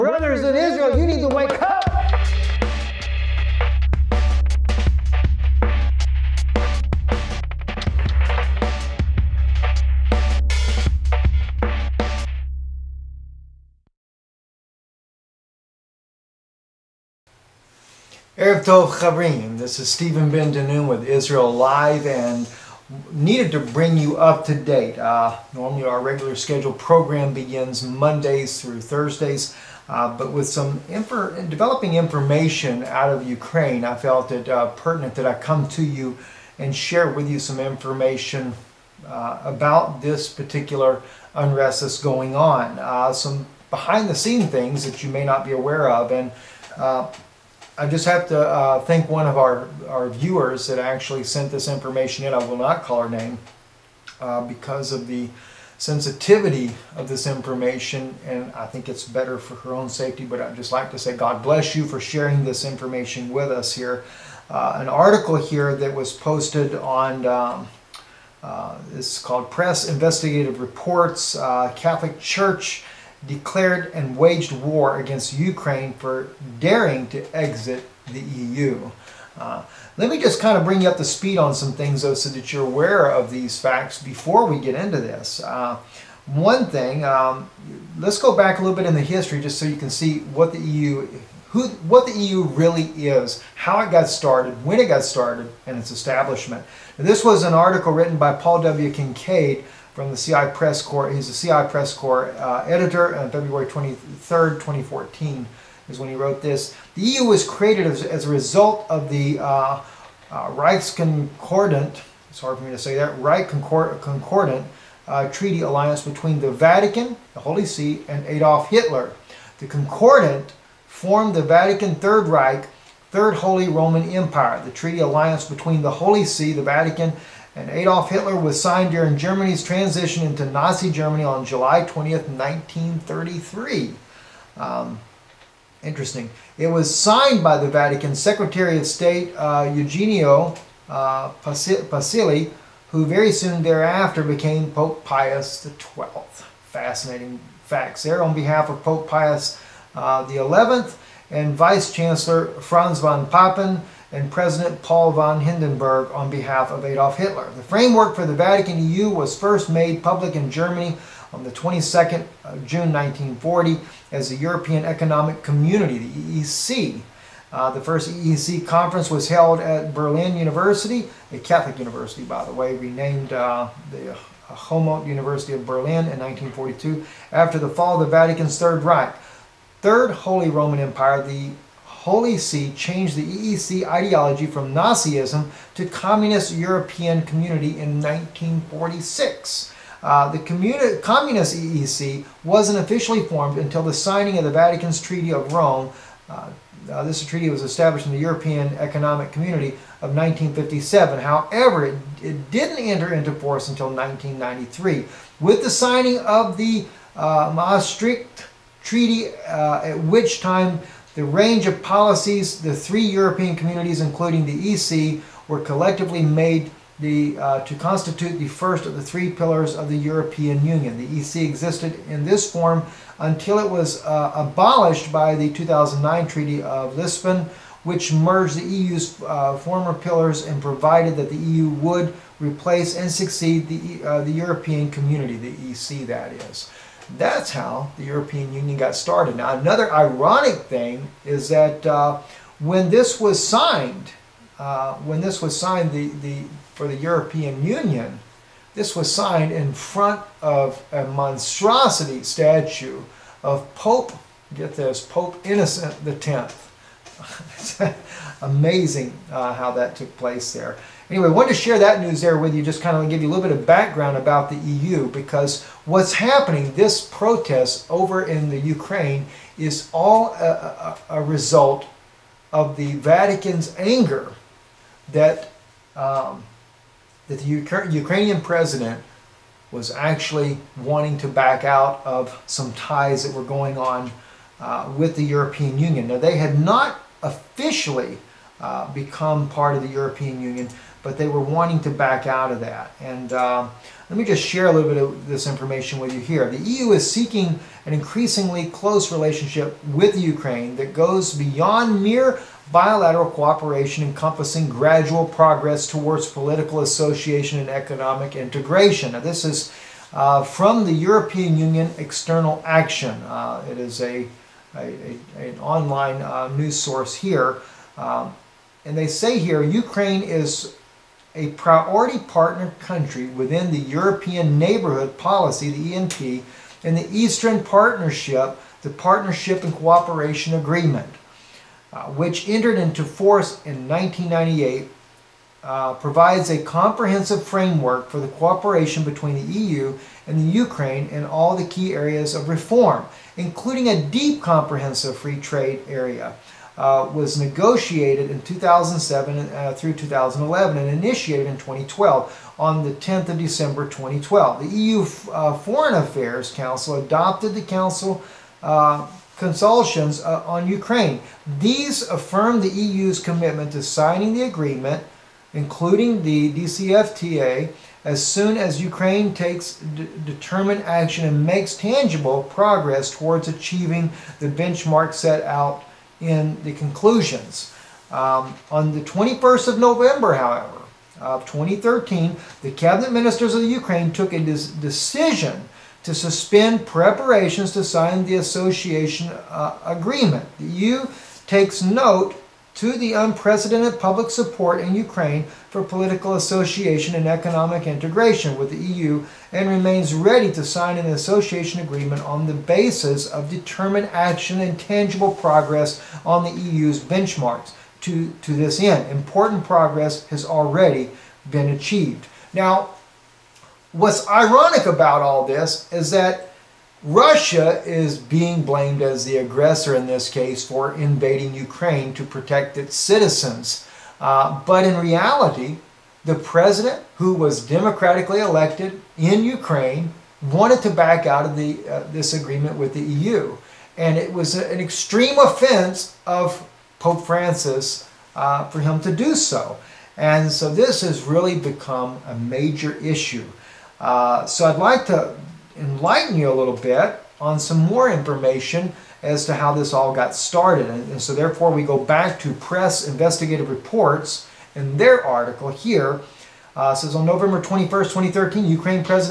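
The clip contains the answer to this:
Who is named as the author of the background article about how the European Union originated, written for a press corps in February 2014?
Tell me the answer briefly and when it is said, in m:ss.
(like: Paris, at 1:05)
Paul W. Kincaid, at 1:38.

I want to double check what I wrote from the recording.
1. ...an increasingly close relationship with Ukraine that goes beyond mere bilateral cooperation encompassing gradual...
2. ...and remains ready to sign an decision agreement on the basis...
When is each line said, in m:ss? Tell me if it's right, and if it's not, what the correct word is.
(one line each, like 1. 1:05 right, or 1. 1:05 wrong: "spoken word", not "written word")
1. 4:57 right
2. 6:39 wrong: "association", not "decision".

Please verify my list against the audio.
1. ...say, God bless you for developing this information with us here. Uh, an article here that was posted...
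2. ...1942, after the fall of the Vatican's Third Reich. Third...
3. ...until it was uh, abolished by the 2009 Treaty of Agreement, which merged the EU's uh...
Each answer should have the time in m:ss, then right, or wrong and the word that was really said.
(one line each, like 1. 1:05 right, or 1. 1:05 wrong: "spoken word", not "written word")
1. 1:00 wrong: "sharing", not "developing"
2. 2:56 right
3. 3:43 wrong: "Lisbon", not "Agreement".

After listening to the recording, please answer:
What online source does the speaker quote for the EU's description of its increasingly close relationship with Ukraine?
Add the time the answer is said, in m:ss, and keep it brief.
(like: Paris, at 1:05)
European Union External Action, at 5:10.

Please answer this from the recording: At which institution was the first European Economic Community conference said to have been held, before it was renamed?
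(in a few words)
Berlin University.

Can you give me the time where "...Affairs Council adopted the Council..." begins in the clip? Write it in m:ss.
5:55.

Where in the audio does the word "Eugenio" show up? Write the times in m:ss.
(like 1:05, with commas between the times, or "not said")
2:19.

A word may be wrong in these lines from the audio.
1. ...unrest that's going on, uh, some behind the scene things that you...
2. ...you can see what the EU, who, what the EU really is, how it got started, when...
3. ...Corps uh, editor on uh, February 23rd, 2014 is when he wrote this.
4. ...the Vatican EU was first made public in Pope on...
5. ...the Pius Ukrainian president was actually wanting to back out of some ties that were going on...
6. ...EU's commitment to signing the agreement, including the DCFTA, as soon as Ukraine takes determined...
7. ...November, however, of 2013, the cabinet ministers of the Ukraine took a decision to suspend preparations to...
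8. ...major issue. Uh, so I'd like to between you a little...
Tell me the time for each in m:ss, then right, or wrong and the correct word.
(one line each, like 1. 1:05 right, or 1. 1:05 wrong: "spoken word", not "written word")
1. 0:41 right
2. 1:29 right
3. 1:41 right
4. 2:38 wrong: "Germany", not "Pope"
5. 4:37 wrong: "Ukra", not "Pius"
6. 6:02 right
7. 6:19 right
8. 7:22 wrong: "enlighten", not "between".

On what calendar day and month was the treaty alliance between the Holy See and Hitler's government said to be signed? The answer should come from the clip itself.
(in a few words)
July 20th.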